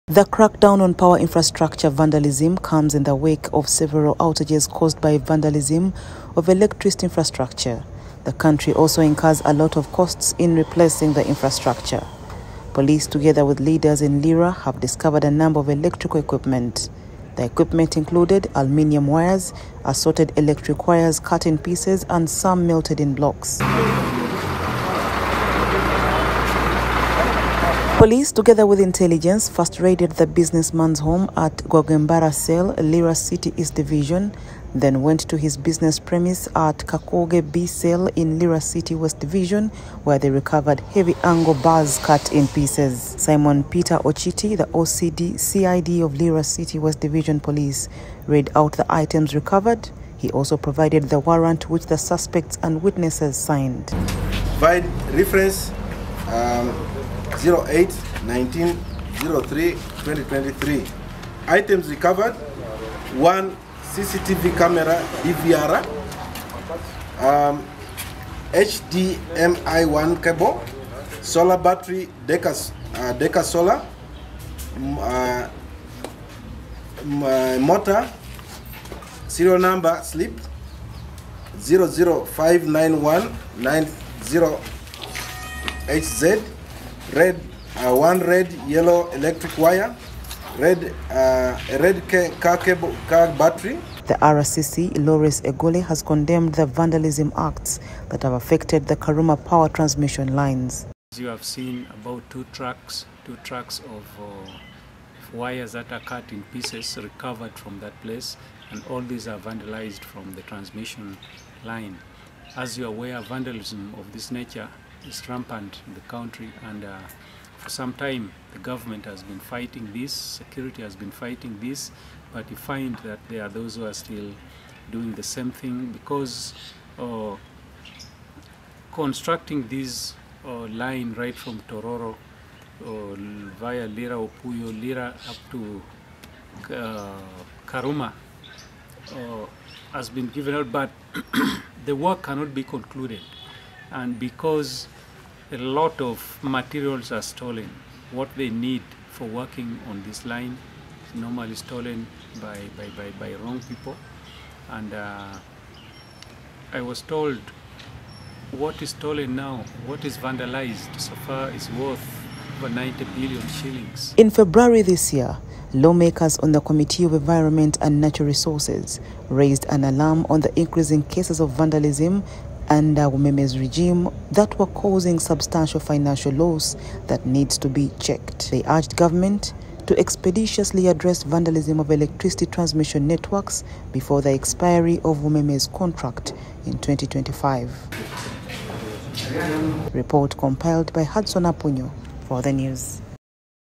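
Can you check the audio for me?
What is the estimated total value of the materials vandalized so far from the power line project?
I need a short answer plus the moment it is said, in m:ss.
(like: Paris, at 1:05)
Over 90 billion shillings, at 2:42.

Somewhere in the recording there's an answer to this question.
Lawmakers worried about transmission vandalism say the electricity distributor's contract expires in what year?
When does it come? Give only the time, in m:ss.
3:06.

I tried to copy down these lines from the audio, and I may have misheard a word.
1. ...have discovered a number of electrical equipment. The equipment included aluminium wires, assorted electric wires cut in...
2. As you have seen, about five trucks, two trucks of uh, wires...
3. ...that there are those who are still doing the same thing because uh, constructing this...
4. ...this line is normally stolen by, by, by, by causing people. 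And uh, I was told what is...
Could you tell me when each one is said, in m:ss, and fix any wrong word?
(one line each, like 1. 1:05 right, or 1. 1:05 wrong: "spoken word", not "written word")
1. 0:14 right
2. 1:41 wrong: "two", not "five"
3. 2:02 right
4. 2:30 wrong: "wrong", not "causing".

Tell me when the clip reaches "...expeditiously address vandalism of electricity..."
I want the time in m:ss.
2:59.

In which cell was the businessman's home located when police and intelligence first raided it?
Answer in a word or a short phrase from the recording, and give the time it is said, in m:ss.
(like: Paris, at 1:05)
Gogembara Cell, at 0:31.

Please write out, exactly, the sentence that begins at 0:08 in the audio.
The country also incurs a lot of costs in replacing the infrastructure.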